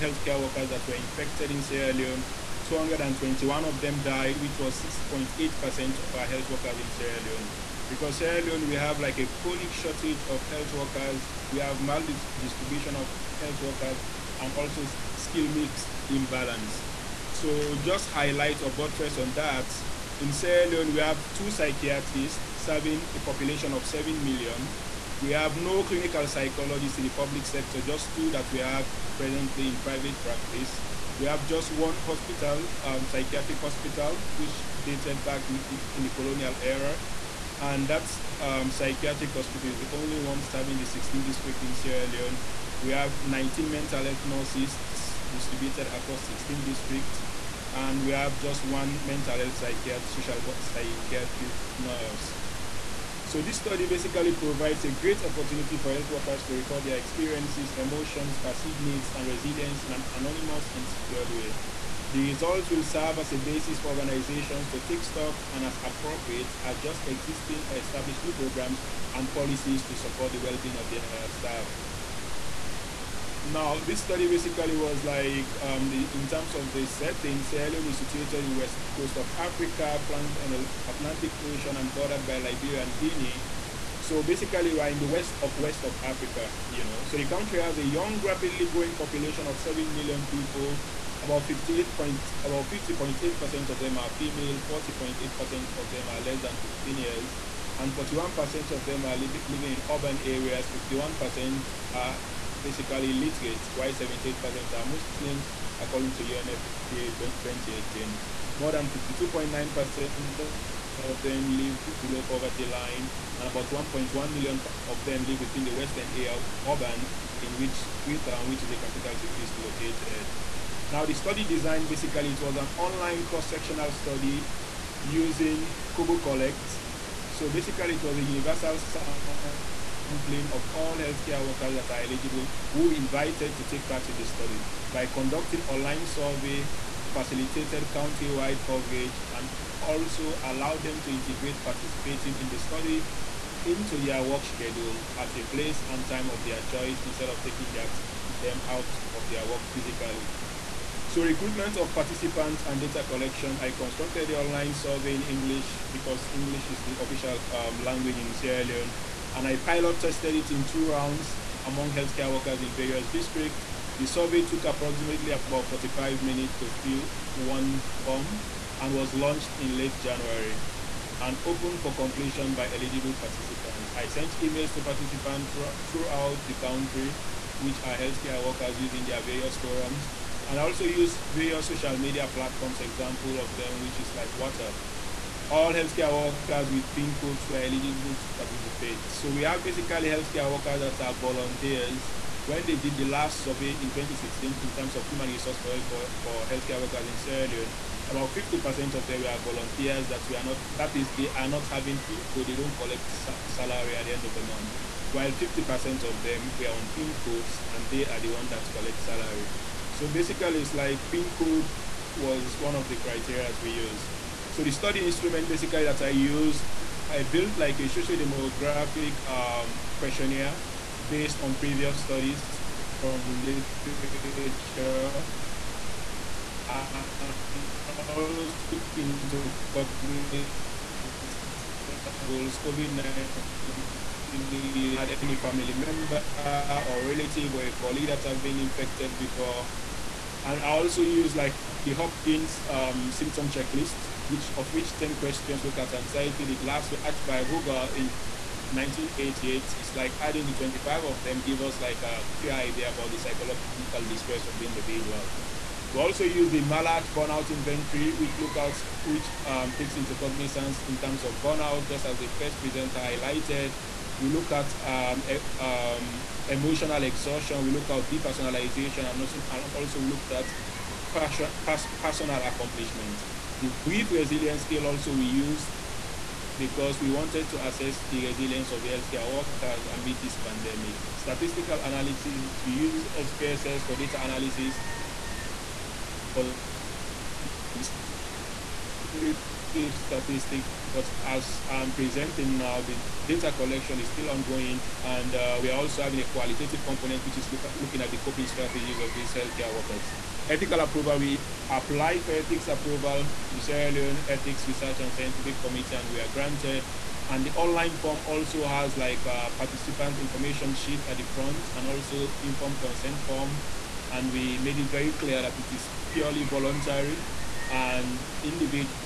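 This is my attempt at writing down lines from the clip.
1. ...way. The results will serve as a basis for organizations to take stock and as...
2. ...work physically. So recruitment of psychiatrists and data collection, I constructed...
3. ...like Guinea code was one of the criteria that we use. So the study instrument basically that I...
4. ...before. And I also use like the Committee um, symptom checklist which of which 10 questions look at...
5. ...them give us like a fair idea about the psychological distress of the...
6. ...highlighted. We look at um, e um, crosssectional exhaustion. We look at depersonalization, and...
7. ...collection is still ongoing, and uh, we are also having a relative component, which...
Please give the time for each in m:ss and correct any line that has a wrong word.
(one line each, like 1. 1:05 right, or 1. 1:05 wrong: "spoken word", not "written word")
1. 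1:01 right
2. 2:29 wrong: "participants", not "psychiatrists"
3. 3:30 wrong: "PIN", not "Guinea"
4. 3:59 wrong: "Hopkins", not "Committee"
5. 4:11 right
6. 4:23 wrong: "emotional", not "crosssectional"
7. 4:53 wrong: "qualitative", not "relative".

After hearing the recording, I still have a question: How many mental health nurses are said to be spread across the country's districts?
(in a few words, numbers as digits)
19.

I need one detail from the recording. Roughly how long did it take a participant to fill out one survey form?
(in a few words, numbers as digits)
45 minutes.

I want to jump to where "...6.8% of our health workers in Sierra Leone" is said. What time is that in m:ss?
0:04.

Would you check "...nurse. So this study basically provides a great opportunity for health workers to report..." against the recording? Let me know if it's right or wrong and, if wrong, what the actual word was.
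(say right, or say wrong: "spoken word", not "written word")
right.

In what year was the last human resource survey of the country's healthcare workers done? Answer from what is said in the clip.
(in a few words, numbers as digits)
2016.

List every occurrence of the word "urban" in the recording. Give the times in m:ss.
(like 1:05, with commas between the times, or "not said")
1:39, 1:56.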